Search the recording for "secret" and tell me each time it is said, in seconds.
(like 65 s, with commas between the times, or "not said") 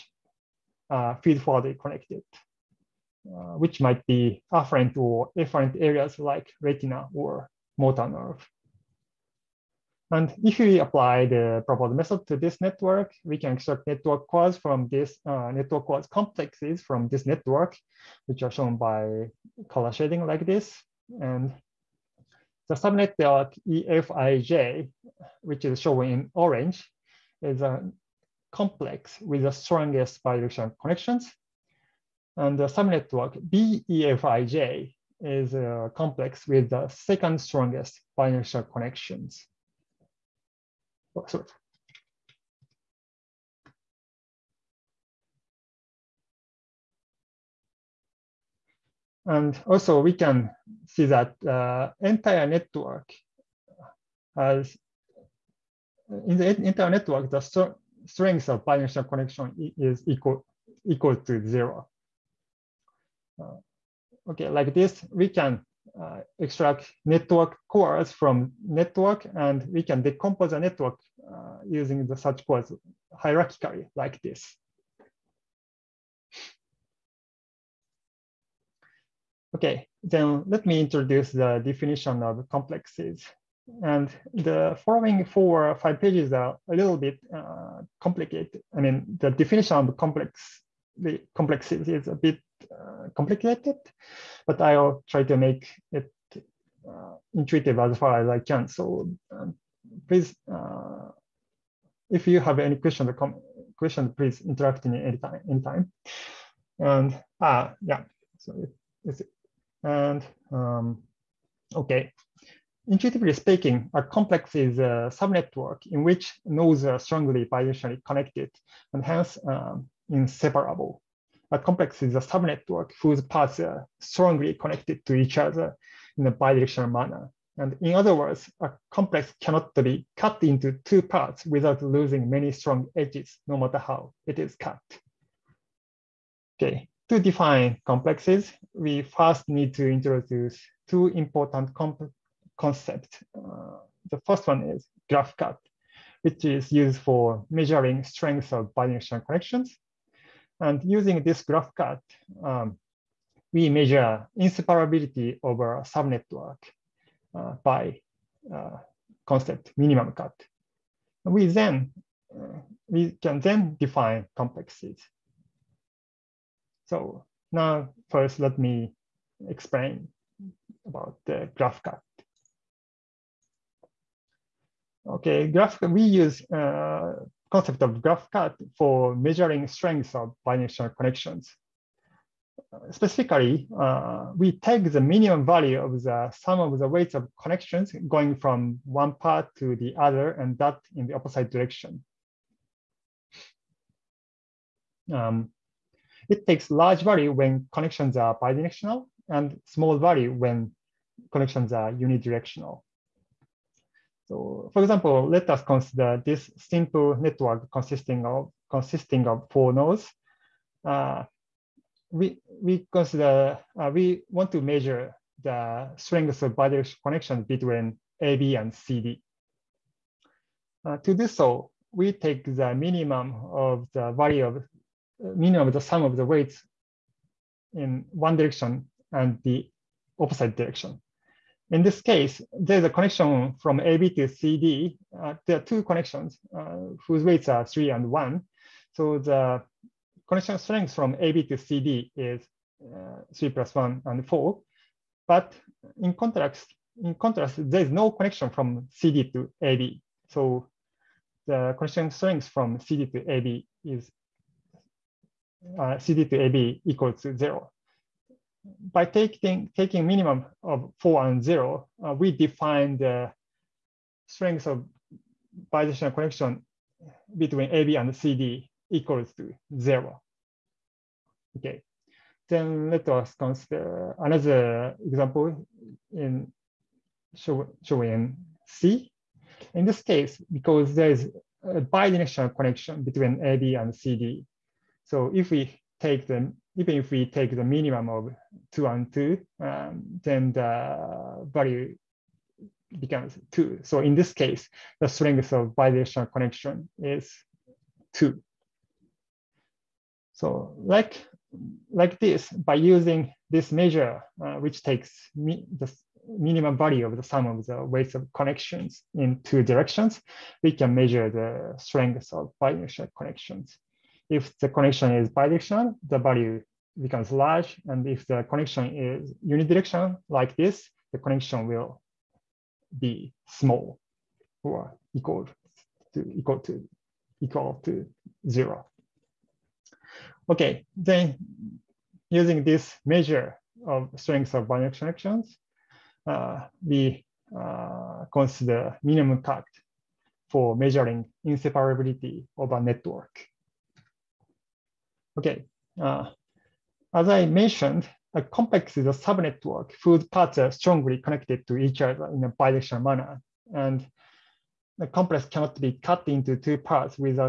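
not said.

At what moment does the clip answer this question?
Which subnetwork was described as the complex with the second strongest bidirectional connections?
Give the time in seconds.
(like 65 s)
33 s.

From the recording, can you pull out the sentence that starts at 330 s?
Okay, then using this measure of strength of binary connections, uh, we uh, consider minimum cut for measuring inseparability of a network.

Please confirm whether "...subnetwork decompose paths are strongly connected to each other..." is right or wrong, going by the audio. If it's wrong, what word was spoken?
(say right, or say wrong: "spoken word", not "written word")
wrong: "whose", not "decompose".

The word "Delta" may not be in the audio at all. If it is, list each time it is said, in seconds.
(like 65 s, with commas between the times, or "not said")
not said.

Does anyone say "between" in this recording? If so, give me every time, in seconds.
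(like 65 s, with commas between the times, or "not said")
217 s, 267 s, 283 s.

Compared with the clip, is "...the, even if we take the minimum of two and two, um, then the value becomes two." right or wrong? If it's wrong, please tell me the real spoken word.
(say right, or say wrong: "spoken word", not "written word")
right.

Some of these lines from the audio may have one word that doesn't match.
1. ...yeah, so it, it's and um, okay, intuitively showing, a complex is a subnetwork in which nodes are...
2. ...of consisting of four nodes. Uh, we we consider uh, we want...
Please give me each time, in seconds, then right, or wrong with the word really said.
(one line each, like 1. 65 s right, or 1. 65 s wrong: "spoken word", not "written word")
1. 107 s wrong: "speaking", not "showing"
2. 208 s right.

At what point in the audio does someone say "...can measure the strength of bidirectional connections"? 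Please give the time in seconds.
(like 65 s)
310 s.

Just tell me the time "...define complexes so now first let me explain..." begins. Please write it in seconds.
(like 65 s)
163 s.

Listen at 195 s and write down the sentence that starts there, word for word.
Um, it takes large value when connections are bidirectional and small value when connections are unidirectional.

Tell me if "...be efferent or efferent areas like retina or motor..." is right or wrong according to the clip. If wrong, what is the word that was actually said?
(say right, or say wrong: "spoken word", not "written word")
wrong: "afferent", not "efferent".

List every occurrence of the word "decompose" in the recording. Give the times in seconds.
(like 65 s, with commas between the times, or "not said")
70 s.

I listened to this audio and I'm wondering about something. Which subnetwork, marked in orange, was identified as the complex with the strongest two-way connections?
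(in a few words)
EFIJ.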